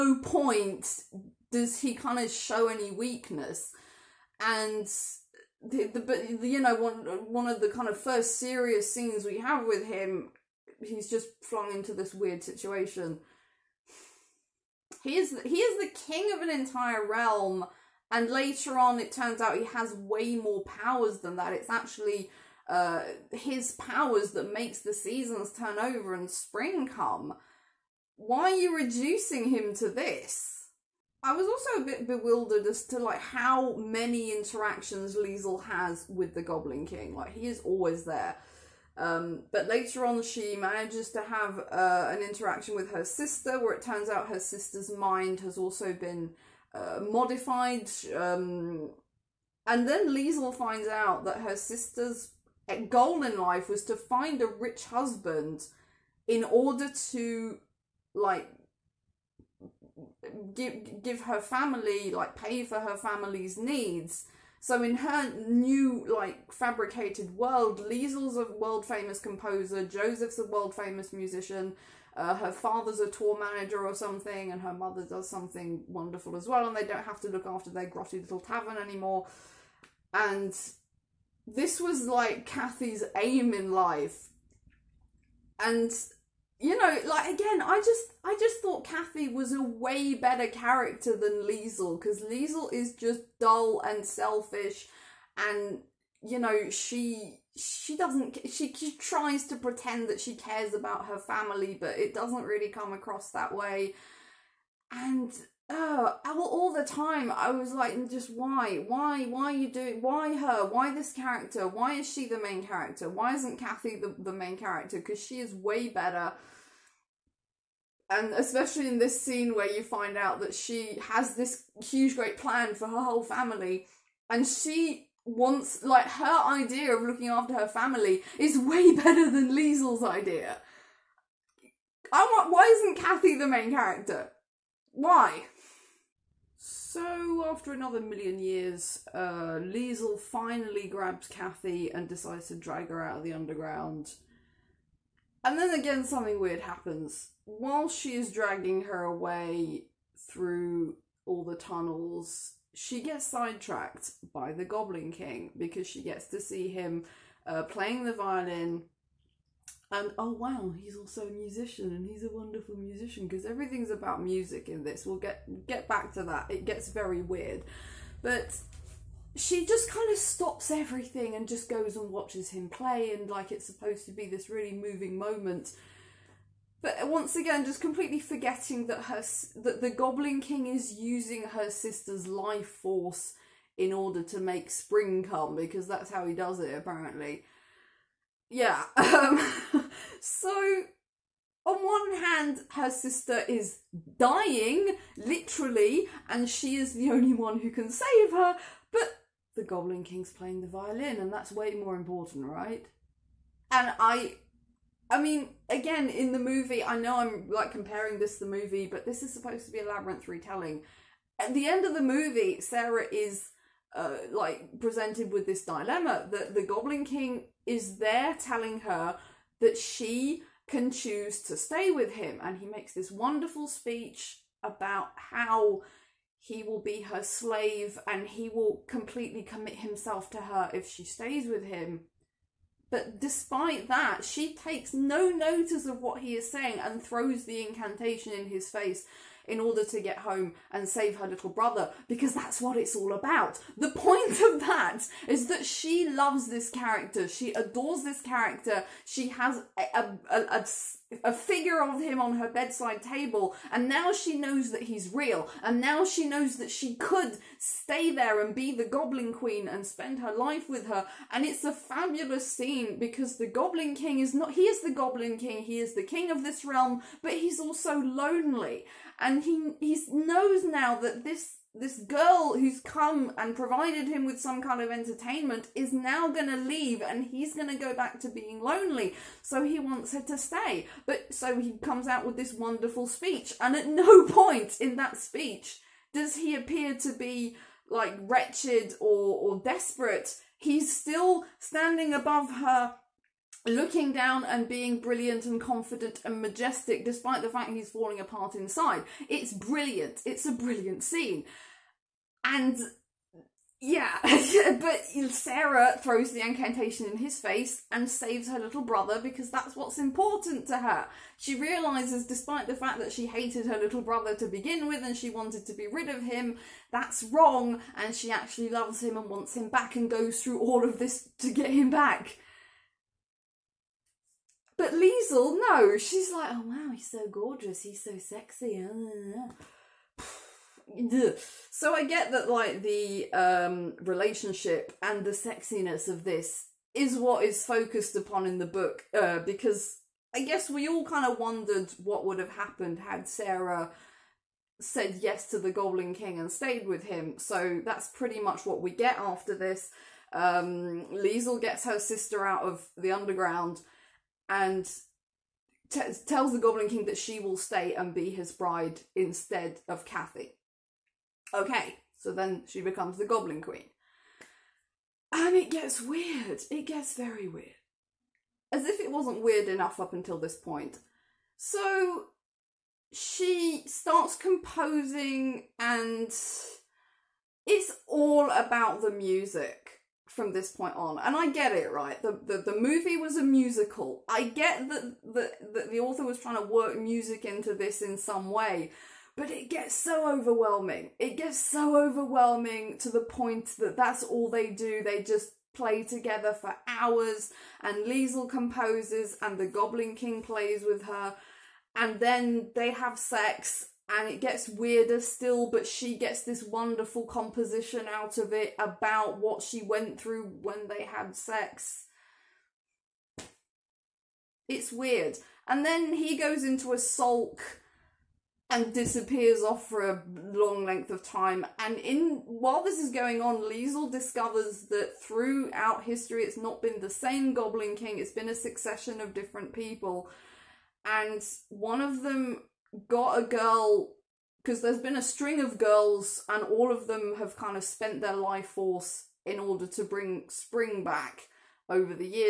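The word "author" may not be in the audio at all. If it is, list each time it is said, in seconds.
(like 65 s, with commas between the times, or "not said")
385 s.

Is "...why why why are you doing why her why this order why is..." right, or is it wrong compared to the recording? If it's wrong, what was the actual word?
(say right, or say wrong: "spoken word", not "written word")
wrong: "character", not "order".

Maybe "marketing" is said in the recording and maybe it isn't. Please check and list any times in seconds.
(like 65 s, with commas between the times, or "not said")
not said.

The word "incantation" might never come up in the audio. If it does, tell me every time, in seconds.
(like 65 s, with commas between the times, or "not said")
237 s, 306 s.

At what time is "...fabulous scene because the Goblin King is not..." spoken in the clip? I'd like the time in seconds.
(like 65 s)
261 s.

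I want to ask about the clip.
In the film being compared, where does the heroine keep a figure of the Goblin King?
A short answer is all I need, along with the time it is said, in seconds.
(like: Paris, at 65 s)
Bedside table, at 252 s.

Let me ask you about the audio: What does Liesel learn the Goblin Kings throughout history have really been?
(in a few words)
A succession of different people.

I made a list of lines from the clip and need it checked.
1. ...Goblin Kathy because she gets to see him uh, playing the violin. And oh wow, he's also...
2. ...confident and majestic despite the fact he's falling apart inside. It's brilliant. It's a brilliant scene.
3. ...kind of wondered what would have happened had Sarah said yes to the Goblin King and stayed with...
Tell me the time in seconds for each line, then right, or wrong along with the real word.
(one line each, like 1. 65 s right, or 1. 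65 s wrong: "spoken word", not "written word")
1. 154 s wrong: "King", not "Kathy"
2. 295 s right
3. 341 s right.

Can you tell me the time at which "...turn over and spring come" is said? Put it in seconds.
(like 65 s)
25 s.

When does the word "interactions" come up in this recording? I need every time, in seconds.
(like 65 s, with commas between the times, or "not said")
34 s, 42 s.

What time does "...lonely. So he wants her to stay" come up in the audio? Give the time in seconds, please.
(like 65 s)
278 s.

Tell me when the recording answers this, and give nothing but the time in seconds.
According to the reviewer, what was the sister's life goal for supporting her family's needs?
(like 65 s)
53 s.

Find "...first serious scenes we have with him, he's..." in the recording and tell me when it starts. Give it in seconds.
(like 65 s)
7 s.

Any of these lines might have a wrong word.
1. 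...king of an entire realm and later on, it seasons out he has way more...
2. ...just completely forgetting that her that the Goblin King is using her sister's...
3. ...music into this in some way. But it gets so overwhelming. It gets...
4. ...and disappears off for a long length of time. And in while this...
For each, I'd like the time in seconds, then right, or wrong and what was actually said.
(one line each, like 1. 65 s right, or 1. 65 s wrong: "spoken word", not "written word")
1. 16 s wrong: "turns", not "seasons"
2. 177 s right
3. 386 s right
4. 418 s right.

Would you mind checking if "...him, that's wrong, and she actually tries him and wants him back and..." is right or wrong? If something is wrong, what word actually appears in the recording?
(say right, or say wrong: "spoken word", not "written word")
wrong: "loves", not "tries".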